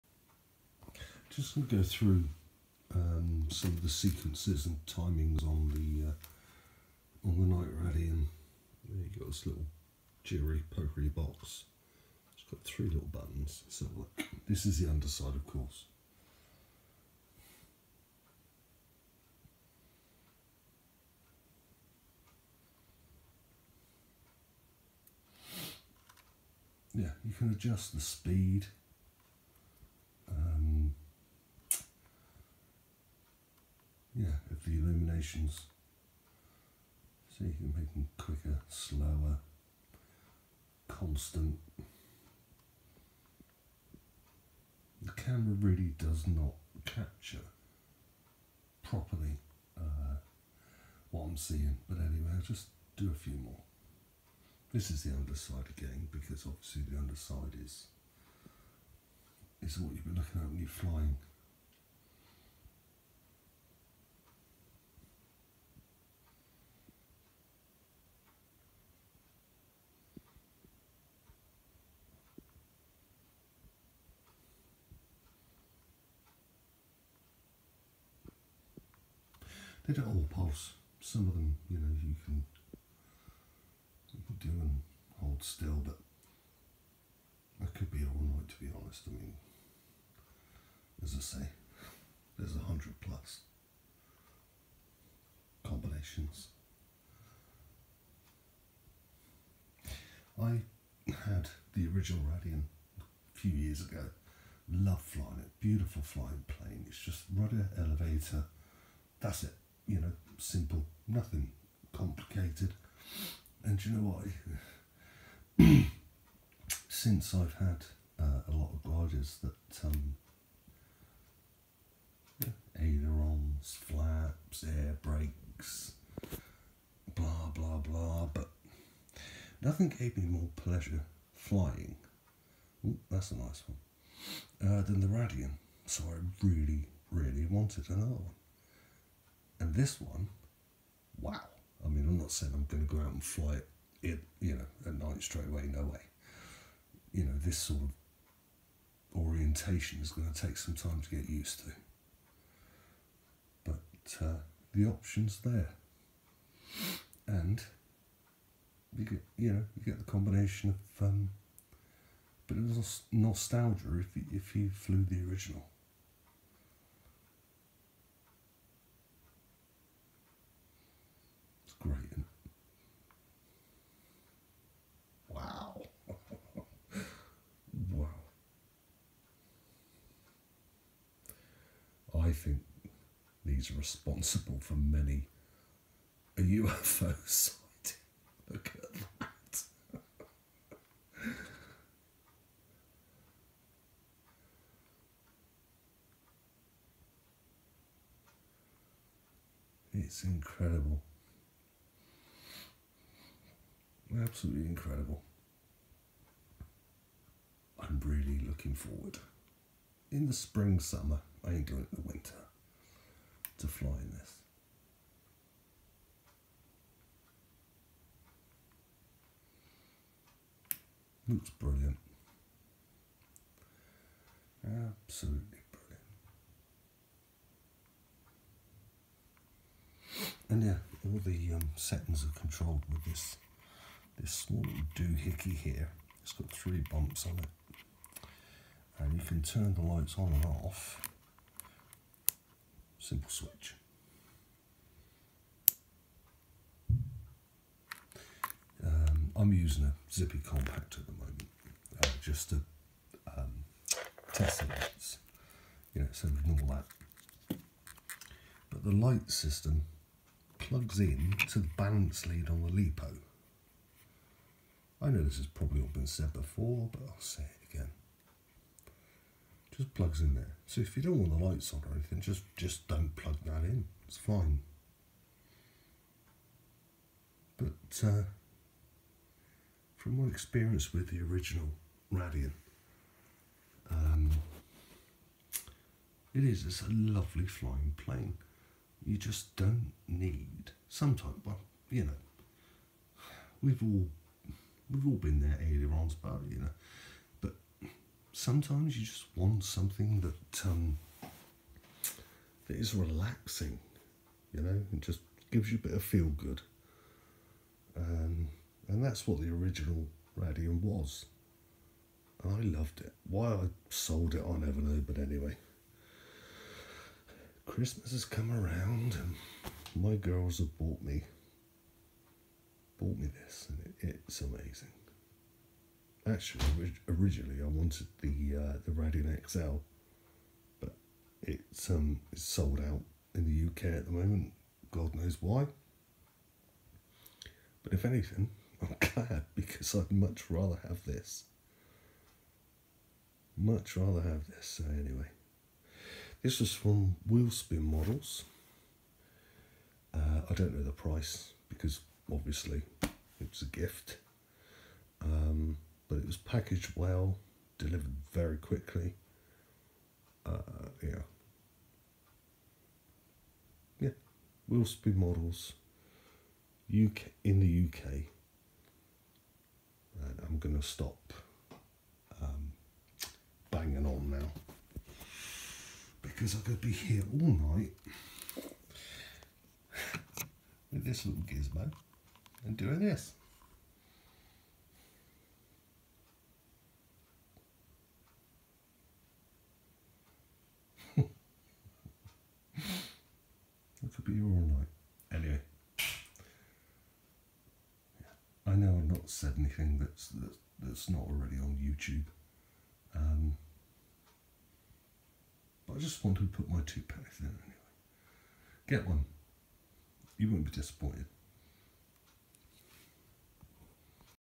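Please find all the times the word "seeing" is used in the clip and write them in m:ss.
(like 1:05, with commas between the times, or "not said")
0:51.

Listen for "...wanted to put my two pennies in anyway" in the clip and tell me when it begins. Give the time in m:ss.
6:46.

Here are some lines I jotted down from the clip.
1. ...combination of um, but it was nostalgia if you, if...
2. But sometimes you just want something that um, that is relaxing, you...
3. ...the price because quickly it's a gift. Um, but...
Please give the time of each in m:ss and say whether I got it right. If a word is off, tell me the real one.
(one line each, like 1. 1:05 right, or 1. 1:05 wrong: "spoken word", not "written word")
1. 2:40 right
2. 4:57 right
3. 5:50 wrong: "obviously", not "quickly".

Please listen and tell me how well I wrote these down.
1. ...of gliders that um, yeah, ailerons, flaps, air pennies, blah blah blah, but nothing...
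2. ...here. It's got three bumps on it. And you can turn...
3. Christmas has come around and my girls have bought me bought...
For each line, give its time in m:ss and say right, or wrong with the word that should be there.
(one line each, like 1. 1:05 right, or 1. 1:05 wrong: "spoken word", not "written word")
1. 1:58 wrong: "brakes", not "pennies"
2. 3:55 right
3. 5:17 right.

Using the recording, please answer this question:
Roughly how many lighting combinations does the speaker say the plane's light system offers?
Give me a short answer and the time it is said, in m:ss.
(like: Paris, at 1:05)
100+, at 1:32.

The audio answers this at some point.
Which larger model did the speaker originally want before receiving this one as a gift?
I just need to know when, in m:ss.
5:28.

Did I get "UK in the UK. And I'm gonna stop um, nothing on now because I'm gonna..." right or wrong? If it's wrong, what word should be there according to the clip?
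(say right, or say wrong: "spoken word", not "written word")
wrong: "banging", not "nothing".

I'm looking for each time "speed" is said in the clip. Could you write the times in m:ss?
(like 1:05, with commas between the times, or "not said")
0:28, 6:04.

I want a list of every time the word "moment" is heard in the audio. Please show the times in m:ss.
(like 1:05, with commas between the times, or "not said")
4:11, 5:34.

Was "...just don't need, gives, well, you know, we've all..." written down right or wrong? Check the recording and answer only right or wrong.
wrong.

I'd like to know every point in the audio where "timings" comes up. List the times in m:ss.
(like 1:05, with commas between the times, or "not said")
0:04.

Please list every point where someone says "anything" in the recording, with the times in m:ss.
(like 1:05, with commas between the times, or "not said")
4:31, 5:38, 6:39.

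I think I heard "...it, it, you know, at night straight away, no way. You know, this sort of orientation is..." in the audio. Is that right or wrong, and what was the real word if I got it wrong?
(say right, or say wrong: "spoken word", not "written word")
right.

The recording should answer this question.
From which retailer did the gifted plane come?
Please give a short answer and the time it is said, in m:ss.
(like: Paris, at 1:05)
Wheelspin Models, at 5:47.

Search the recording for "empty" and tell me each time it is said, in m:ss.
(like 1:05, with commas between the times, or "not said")
not said.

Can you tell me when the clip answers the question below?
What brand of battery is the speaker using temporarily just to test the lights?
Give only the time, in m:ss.
4:10.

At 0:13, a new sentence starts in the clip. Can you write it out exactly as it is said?
So this is the underside, of course.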